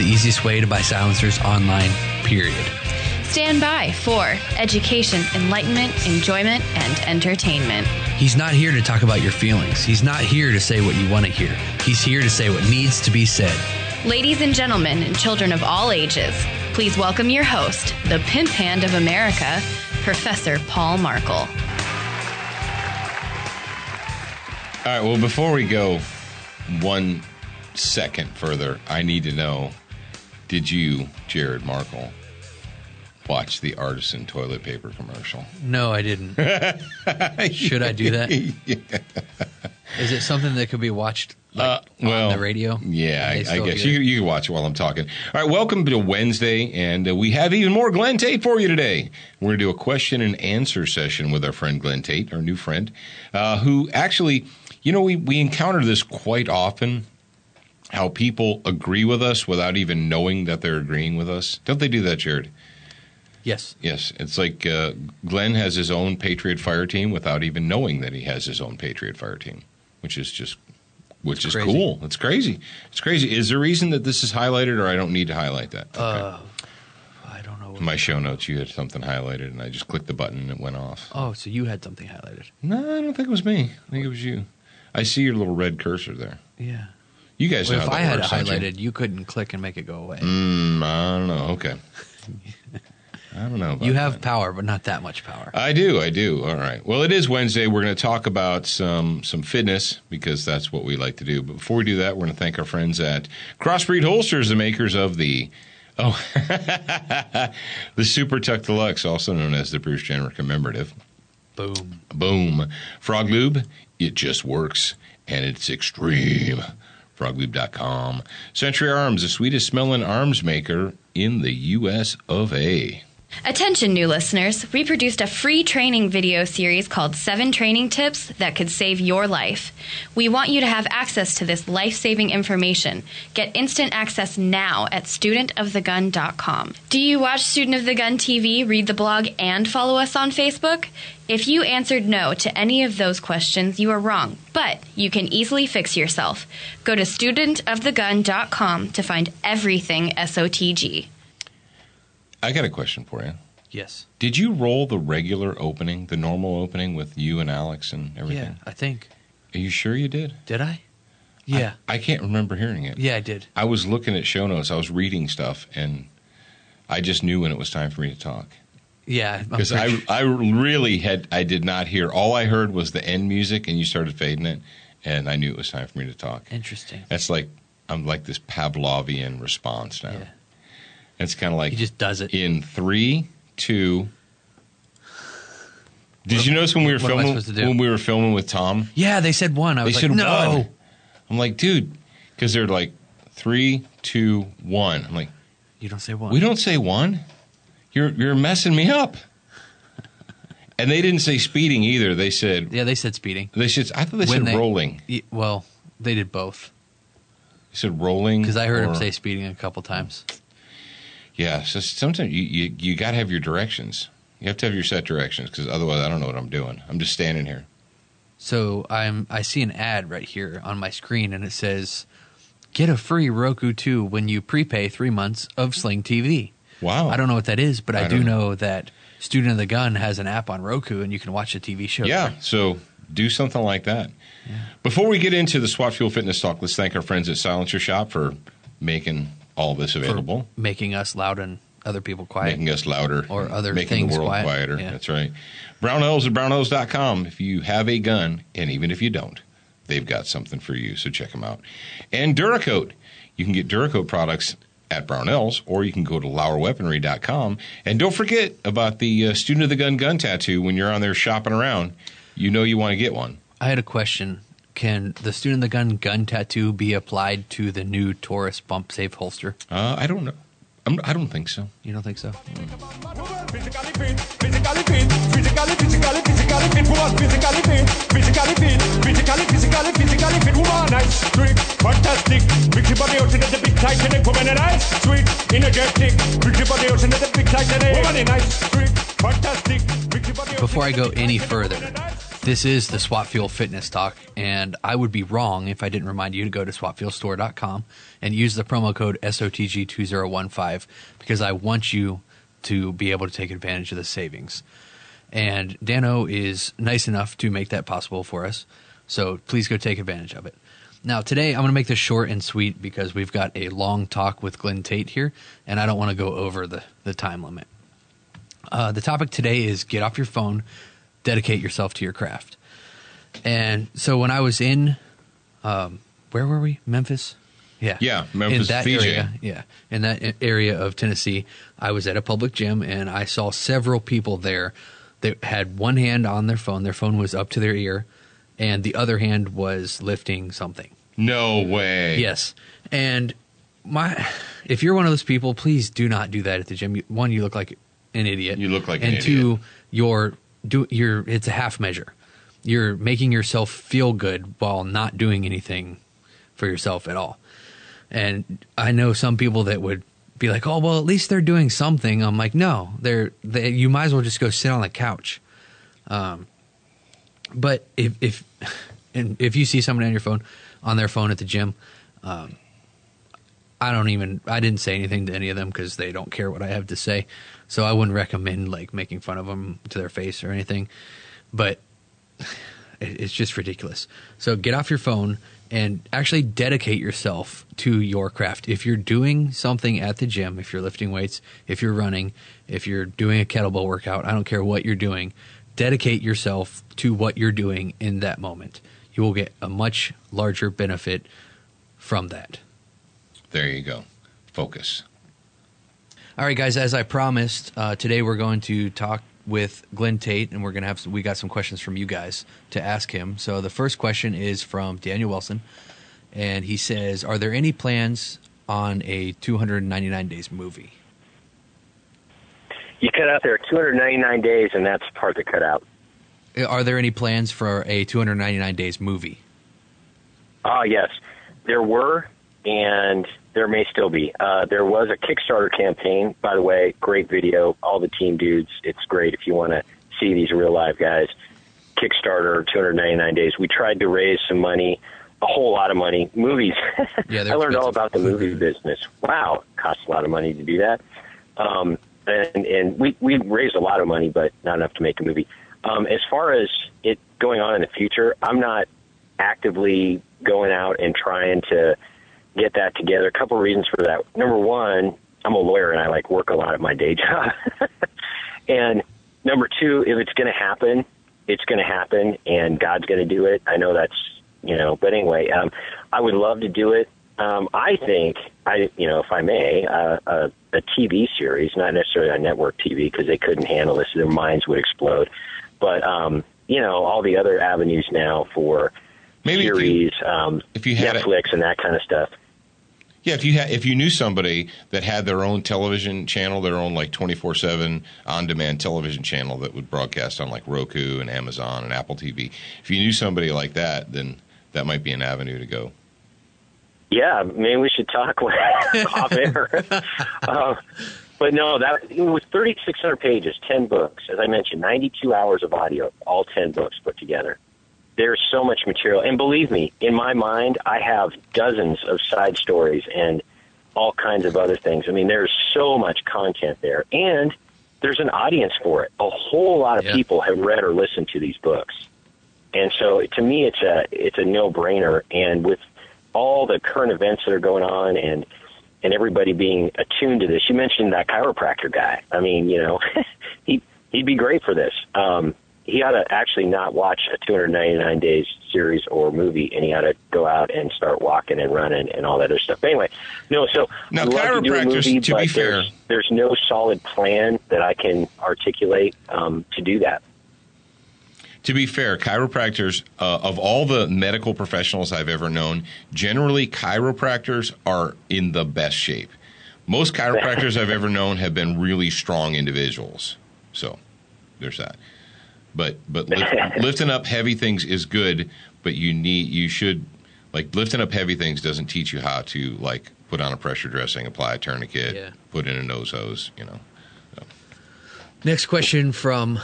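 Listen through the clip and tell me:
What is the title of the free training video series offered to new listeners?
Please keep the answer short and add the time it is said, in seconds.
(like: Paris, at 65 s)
Seven Training Tips That Could Save Your Life, at 127 s.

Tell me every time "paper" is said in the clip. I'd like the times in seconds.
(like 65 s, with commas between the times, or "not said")
34 s.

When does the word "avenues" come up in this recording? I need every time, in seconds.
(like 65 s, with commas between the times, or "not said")
487 s, 505 s.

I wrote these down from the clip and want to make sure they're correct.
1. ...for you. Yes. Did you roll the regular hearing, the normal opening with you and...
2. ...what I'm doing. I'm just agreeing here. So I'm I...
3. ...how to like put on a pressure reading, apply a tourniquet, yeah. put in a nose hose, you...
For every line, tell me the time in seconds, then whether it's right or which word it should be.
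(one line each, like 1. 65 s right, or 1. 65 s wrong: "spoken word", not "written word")
1. 153 s wrong: "opening", not "hearing"
2. 216 s wrong: "standing", not "agreeing"
3. 582 s wrong: "dressing", not "reading".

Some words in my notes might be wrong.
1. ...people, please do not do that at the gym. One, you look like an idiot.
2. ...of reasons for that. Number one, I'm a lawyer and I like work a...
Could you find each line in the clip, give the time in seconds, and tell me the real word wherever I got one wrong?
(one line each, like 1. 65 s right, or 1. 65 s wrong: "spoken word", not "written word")
1. 345 s right
2. 463 s right.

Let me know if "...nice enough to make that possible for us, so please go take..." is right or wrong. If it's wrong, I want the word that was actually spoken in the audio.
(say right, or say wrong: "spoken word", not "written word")
right.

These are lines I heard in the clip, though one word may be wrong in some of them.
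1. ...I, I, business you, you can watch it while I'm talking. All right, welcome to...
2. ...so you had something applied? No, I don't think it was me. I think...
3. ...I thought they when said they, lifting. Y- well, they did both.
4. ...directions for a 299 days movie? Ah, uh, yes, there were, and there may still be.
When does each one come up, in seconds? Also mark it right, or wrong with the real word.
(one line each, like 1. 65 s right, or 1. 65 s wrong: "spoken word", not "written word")
1. 43 s wrong: "guess", not "business"
2. 81 s wrong: "highlighted", not "applied"
3. 203 s wrong: "rolling", not "lifting"
4. 427 s wrong: "plans", not "directions".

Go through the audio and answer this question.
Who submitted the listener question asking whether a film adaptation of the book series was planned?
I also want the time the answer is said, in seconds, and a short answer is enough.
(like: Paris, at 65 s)
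Daniel Wilson, at 414 s.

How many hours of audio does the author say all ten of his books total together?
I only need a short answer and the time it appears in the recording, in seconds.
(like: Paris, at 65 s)
92, at 514 s.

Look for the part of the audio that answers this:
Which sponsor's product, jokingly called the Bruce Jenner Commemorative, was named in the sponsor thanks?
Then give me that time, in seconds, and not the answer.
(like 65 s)
108 s.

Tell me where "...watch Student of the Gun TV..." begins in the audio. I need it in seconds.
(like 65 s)
137 s.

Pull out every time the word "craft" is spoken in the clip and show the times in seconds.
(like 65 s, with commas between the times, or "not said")
322 s, 388 s.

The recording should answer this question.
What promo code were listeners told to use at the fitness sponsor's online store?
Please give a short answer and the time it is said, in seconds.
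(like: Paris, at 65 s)
SOTG2015, at 299 s.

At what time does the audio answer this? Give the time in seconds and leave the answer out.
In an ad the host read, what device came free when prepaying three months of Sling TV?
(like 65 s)
223 s.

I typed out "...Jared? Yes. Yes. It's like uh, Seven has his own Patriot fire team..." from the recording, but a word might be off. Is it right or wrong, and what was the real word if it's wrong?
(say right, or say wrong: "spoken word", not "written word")
wrong: "Glen", not "Seven".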